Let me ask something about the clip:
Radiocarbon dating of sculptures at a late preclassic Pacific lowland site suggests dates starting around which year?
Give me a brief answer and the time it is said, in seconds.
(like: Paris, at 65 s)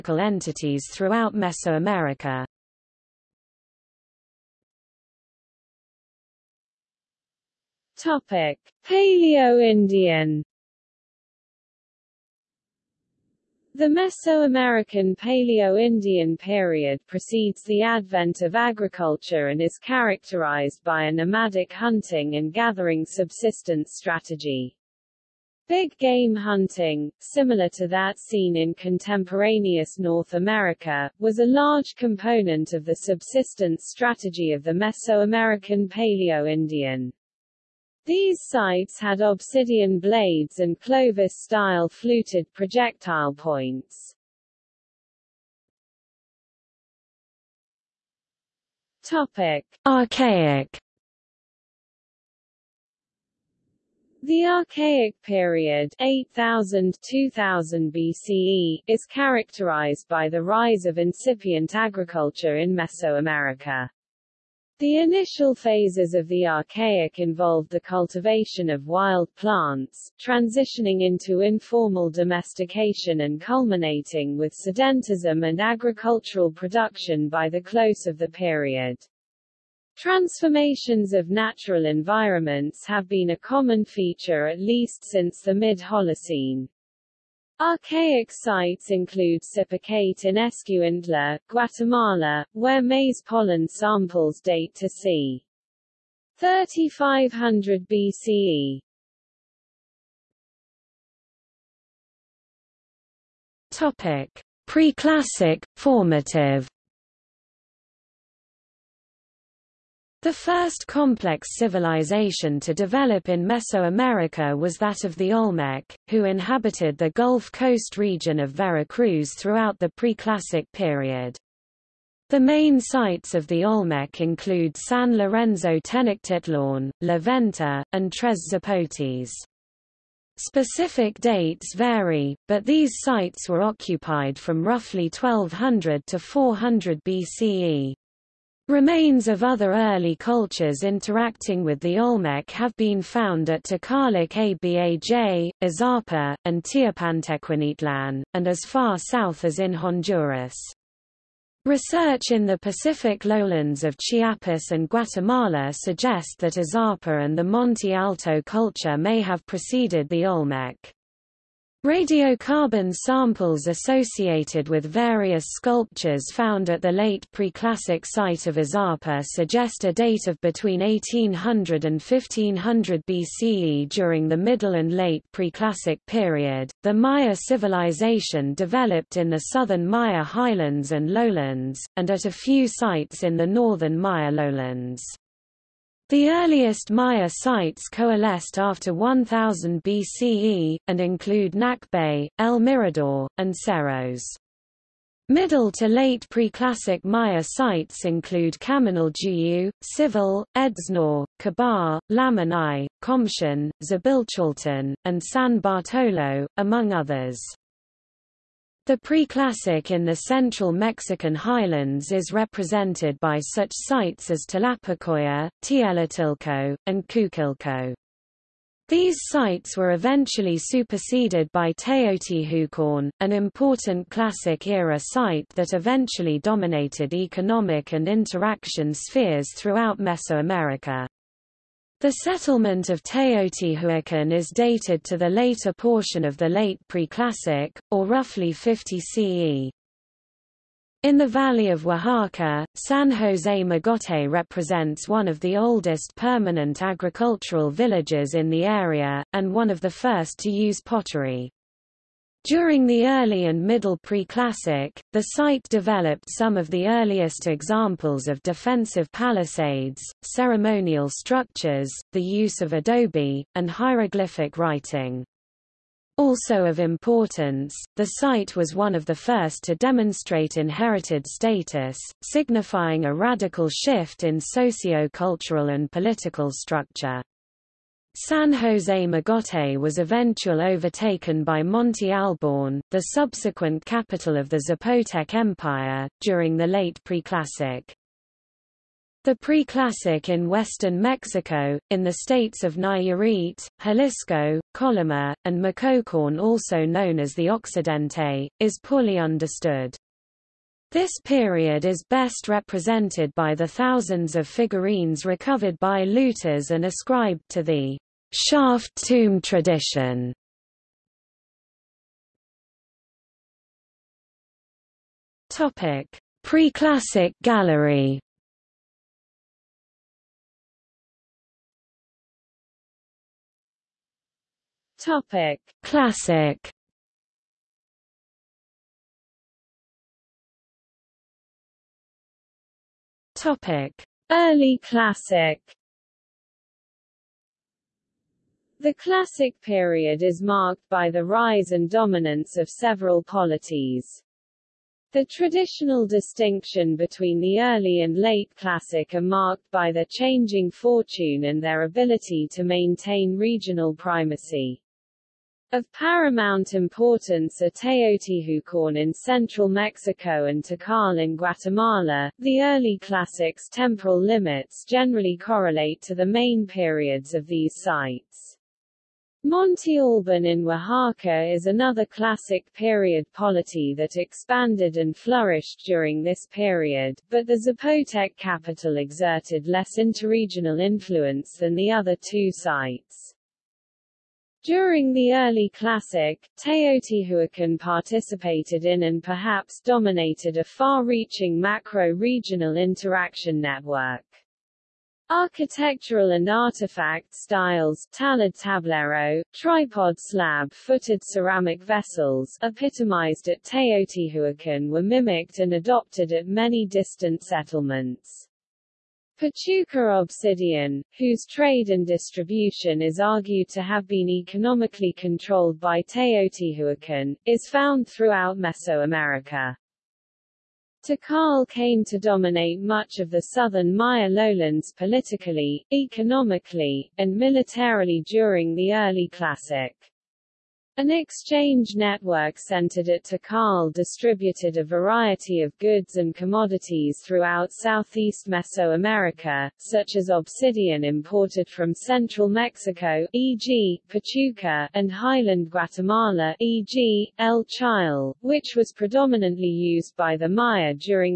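1800 BCE, at 170 s.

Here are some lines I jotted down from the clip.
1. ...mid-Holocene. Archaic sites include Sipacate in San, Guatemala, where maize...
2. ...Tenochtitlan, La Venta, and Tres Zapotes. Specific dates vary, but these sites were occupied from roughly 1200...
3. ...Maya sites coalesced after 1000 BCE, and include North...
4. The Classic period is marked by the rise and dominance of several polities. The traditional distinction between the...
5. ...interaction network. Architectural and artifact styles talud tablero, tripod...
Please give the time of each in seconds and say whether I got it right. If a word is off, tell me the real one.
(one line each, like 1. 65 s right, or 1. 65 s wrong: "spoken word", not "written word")
1. 85 s wrong: "Escuintla", not "San"
2. 125 s right
3. 186 s wrong: "Nakbe", not "North"
4. 338 s right
5. 392 s right.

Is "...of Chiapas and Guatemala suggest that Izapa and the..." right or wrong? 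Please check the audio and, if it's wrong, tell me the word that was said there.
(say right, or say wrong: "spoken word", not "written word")
right.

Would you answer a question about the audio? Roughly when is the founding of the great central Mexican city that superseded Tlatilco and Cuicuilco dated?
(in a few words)
50 CE.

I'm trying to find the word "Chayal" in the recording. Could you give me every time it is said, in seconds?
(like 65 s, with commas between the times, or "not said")
447 s.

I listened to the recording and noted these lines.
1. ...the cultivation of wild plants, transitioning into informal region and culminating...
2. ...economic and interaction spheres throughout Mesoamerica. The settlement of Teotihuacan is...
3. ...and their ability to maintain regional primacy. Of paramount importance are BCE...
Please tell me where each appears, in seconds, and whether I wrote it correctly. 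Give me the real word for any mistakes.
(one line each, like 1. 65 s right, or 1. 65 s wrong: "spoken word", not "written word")
1. 67 s wrong: "domestication", not "region"
2. 227 s right
3. 351 s wrong: "Teotihuacan", not "BCE".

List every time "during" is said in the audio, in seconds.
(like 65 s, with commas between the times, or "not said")
173 s, 252 s, 286 s, 375 s, 384 s, 428 s.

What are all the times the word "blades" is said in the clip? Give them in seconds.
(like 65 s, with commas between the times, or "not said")
39 s.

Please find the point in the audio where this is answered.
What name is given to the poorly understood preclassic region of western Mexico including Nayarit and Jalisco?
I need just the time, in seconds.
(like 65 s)
297 s.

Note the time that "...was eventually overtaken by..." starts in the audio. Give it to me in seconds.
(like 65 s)
279 s.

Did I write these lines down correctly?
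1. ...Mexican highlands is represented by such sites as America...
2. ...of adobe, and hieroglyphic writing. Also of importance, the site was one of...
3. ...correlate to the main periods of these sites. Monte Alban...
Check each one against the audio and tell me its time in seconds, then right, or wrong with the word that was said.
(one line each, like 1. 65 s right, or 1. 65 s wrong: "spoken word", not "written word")
1. 210 s wrong: "Tlapacoya", not "America"
2. 262 s right
3. 365 s right.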